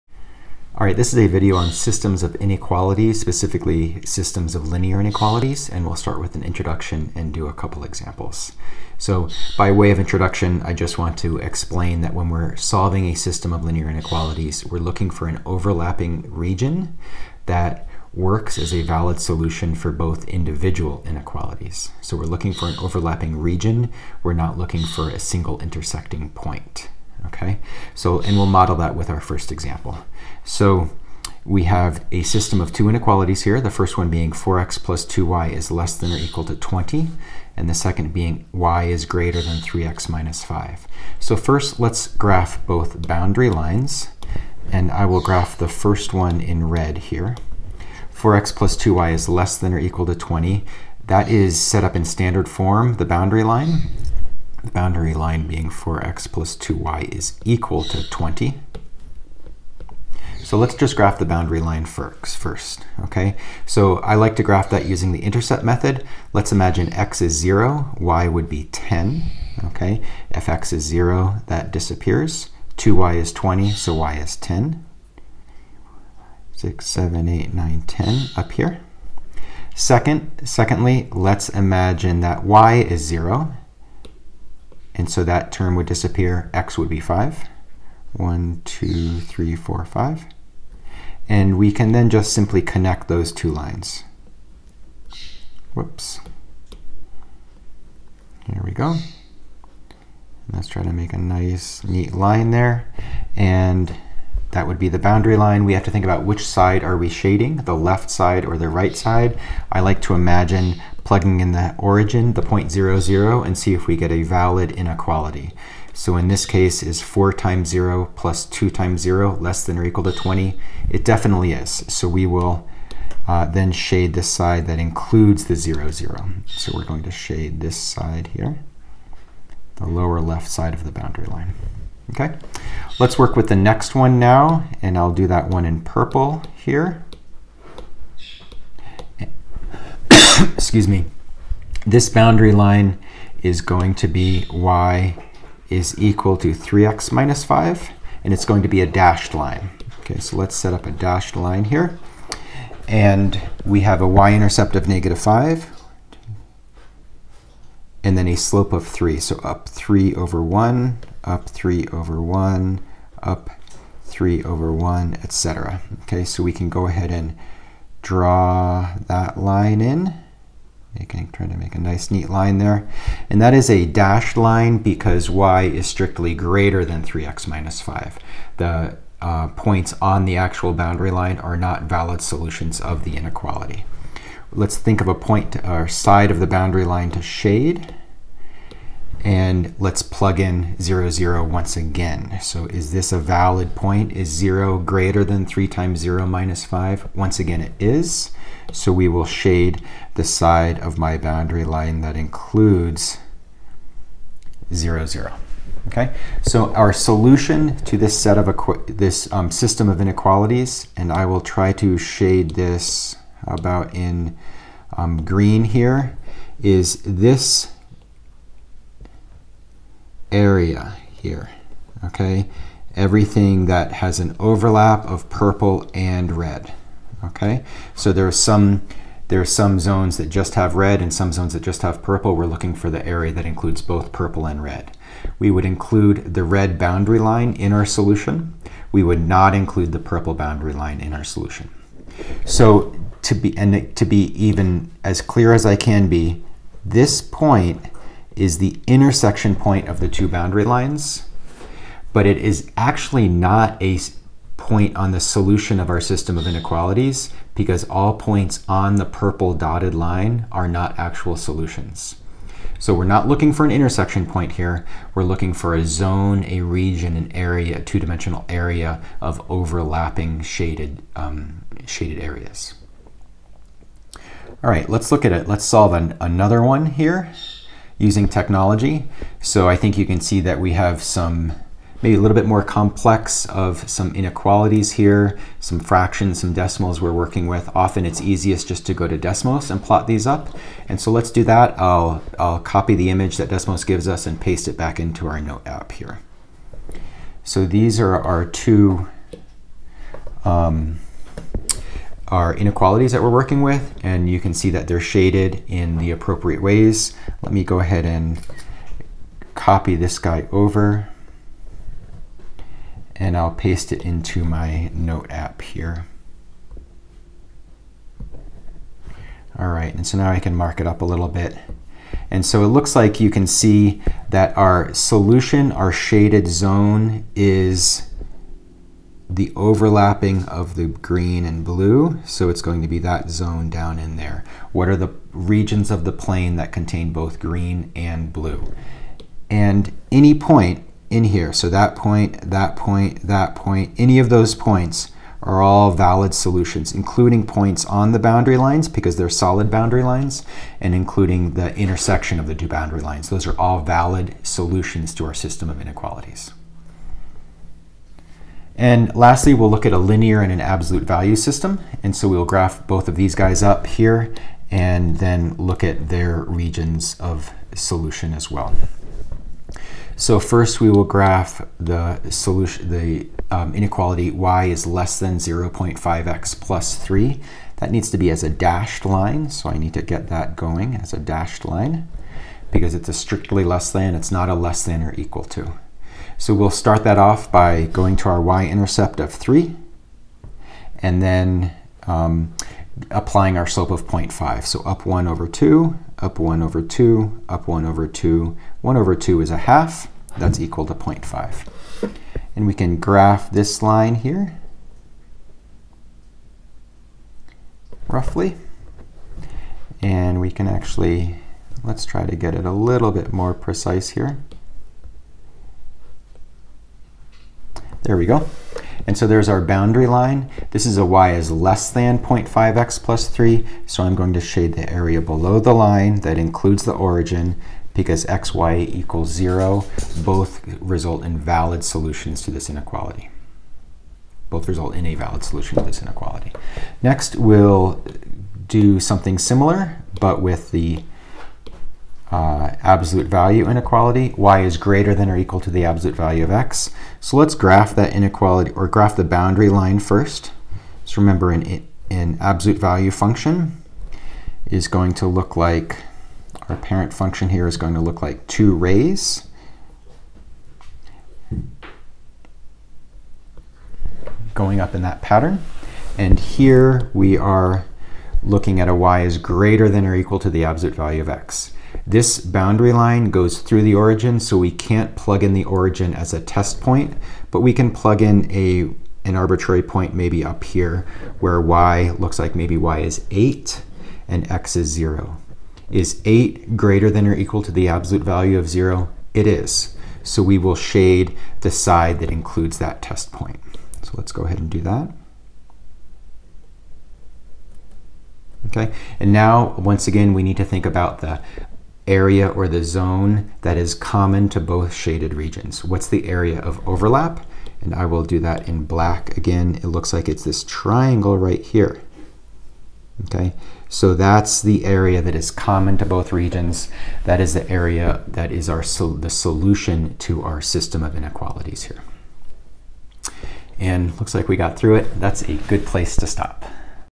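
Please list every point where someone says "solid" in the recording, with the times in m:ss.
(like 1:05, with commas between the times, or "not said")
5:49.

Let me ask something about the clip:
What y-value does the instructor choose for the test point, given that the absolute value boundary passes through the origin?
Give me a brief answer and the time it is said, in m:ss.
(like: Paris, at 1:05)
8, at 8:02.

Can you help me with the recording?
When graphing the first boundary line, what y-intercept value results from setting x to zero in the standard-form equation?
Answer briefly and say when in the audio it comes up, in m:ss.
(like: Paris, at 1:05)
10, at 1:07.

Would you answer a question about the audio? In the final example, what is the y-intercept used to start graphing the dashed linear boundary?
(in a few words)
3.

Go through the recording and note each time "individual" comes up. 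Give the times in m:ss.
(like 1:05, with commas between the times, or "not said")
0:20.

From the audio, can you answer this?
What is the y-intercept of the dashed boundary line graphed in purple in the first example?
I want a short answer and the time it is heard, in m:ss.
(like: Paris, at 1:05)
negative 5, at 2:34.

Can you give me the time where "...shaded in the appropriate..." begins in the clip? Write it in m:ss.
5:05.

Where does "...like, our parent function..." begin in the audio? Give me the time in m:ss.
7:35.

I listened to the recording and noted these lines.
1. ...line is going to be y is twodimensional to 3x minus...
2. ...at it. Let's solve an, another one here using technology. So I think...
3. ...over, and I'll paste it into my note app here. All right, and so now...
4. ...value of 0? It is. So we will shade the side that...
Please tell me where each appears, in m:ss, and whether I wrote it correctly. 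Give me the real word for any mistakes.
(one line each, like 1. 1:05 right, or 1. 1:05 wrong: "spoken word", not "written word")
1. 2:22 wrong: "equal", not "twodimensional"
2. 4:35 right
3. 5:10 right
4. 8:08 right.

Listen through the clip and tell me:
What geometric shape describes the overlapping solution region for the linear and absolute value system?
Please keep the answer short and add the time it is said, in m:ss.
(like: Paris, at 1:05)
triangle, at 8:30.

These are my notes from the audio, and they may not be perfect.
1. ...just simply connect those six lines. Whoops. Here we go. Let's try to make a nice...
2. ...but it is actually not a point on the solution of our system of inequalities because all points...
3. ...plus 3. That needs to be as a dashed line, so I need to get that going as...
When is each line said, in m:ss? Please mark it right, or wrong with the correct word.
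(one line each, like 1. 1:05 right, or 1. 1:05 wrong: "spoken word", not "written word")
1. 1:32 wrong: "two", not "six"
2. 4:12 right
3. 6:16 right.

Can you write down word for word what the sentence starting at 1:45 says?
We have to think about which side are we shading, the left side or the right side.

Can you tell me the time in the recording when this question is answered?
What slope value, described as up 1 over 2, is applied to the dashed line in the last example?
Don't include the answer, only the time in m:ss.
6:33.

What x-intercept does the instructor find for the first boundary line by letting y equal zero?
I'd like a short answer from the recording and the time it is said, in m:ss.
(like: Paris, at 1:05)
5, at 1:26.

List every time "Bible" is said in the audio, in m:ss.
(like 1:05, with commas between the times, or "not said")
not said.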